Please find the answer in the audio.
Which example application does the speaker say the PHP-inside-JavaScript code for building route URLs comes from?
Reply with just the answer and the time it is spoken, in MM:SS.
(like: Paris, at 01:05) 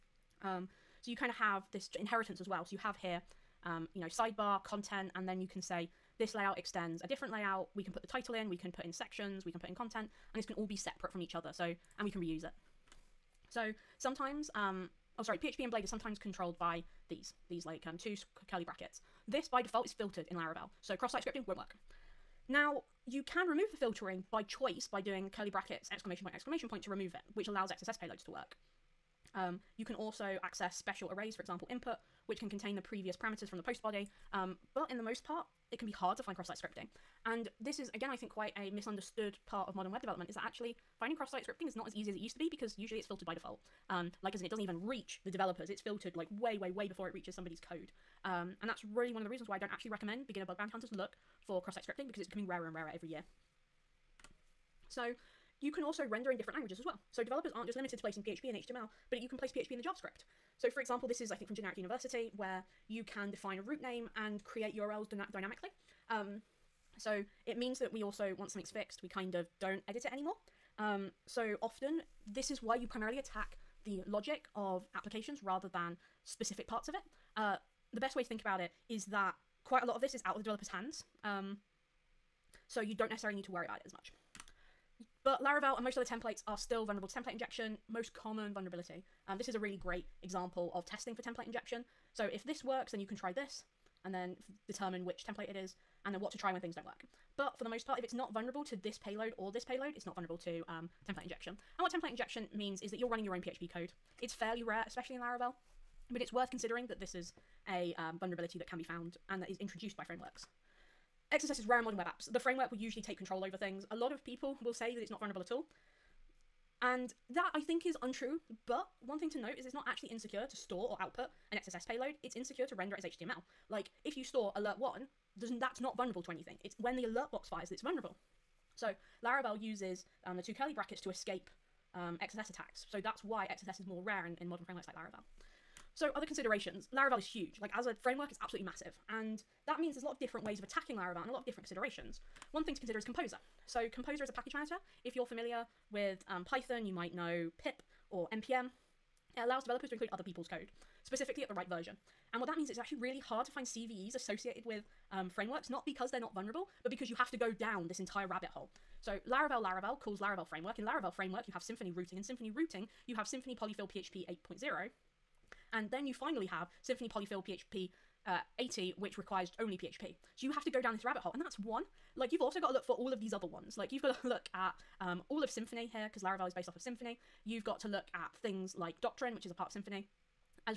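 Generic University, at 01:01.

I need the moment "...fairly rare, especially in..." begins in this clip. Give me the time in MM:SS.
01:44.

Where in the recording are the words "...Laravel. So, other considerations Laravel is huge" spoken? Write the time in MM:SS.
02:14.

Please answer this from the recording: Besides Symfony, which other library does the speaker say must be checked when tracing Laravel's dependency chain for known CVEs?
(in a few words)
Doctrine.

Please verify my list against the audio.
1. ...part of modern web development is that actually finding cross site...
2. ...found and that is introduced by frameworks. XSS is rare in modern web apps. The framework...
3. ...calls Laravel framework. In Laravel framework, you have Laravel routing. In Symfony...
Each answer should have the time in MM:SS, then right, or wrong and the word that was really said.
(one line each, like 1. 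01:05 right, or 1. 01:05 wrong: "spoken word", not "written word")
1. 00:39 right
2. 01:48 right
3. 02:39 wrong: "Symfony", not "Laravel".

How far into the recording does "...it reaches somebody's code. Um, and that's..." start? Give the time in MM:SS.
00:47.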